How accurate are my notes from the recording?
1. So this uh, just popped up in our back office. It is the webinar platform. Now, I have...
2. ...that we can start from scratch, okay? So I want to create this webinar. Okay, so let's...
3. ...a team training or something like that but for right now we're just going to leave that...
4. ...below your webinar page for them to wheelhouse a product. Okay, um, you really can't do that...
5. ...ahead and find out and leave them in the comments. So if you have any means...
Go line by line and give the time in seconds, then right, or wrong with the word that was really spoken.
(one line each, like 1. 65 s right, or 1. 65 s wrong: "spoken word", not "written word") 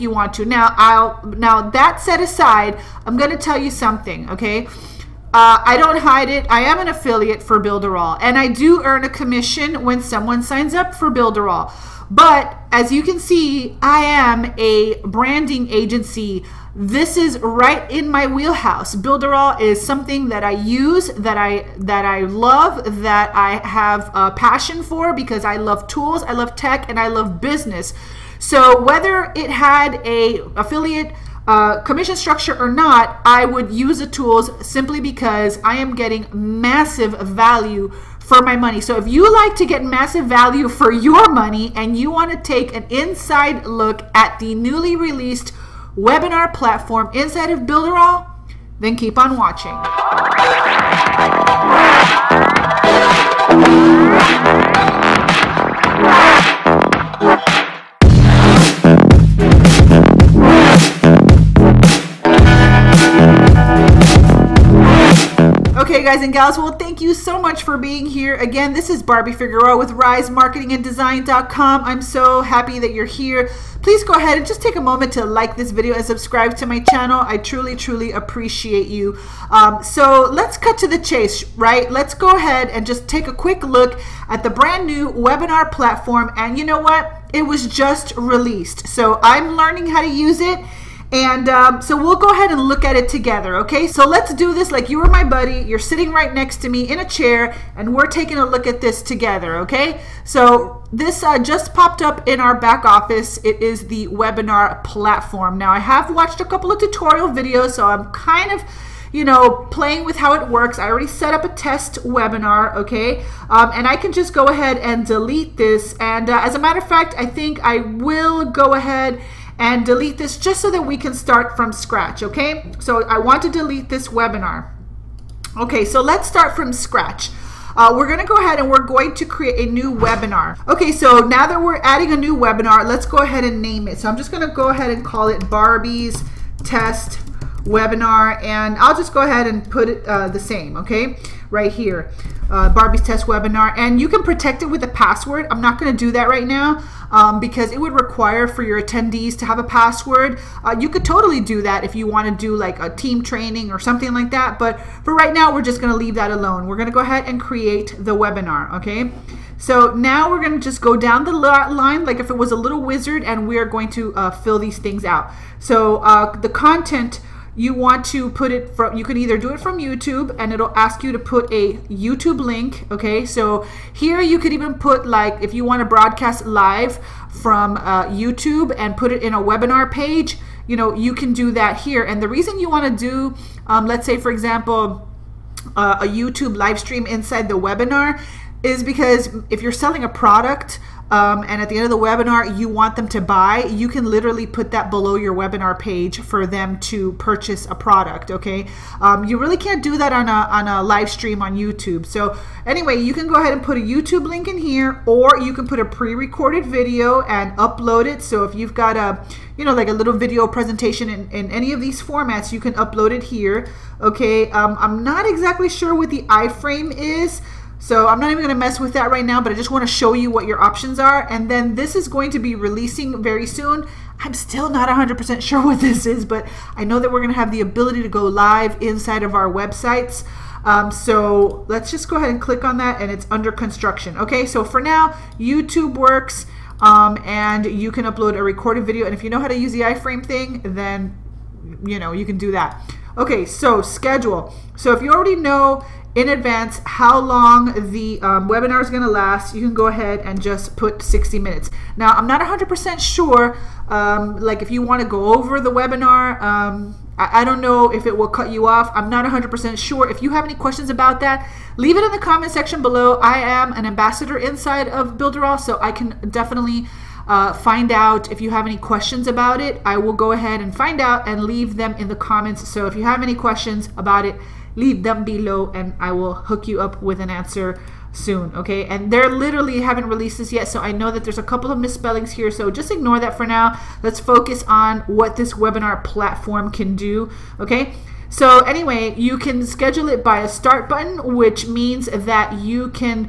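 1. 100 s right
2. 120 s wrong: "delete", not "create"
3. 152 s right
4. 194 s wrong: "purchase", not "wheelhouse"
5. 270 s wrong: "questions", not "means".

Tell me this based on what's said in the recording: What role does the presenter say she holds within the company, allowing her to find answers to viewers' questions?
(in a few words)
ambassador.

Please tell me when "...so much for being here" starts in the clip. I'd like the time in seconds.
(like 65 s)
67 s.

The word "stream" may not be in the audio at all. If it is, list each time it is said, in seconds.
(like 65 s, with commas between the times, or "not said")
186 s, 201 s.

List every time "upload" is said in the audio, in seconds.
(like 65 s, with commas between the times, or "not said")
207 s, 212 s, 238 s.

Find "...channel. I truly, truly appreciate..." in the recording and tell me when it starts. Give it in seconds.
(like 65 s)
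76 s.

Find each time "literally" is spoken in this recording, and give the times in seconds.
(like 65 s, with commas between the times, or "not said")
194 s, 279 s.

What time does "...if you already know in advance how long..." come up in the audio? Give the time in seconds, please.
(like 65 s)
244 s.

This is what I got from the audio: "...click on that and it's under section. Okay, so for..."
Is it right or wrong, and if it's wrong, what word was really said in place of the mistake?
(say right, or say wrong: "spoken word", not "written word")
wrong: "construction", not "section".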